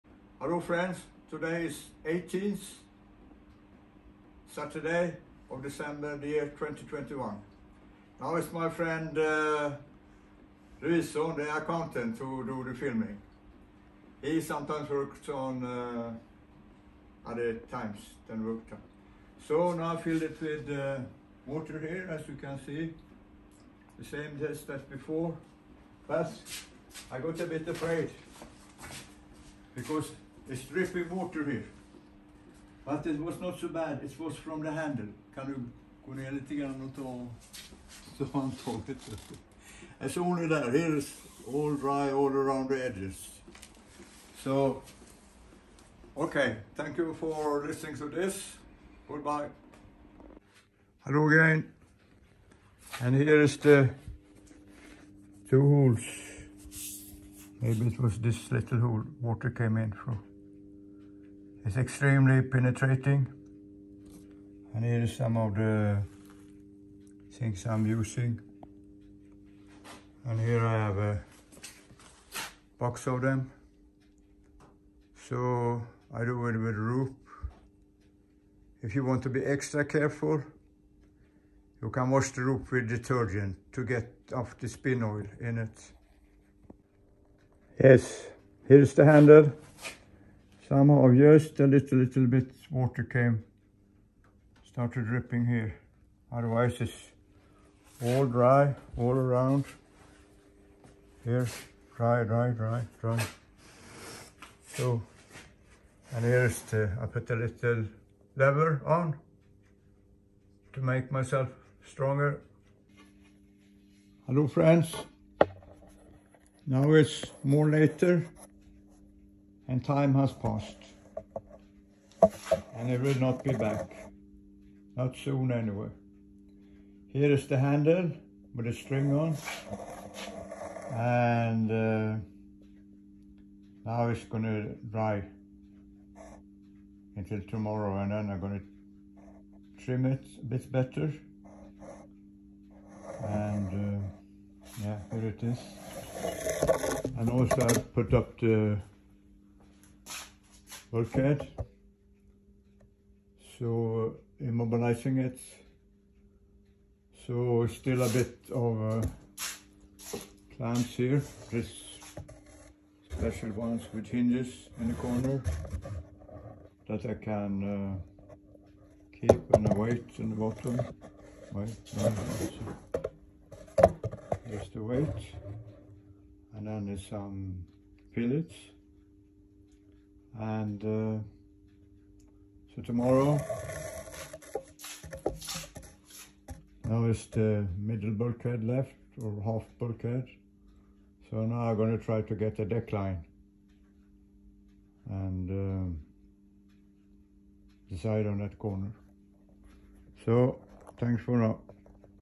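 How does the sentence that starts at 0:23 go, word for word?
The same test as before, but I got a bit afraid because it's dripping water here.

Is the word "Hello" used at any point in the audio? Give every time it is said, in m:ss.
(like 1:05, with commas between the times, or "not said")
0:00, 0:51, 1:54.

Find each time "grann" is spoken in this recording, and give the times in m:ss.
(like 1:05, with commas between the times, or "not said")
0:36.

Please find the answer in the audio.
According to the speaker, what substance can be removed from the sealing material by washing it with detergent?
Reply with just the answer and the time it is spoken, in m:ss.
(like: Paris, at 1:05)
Spin oil, at 1:24.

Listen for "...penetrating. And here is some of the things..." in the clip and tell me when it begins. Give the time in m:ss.
1:02.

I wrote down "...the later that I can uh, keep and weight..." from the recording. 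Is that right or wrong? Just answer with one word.
wrong.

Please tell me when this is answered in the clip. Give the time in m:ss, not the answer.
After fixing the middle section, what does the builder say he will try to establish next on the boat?
3:12.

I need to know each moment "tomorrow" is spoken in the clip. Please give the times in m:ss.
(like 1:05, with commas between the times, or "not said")
2:17, 3:02.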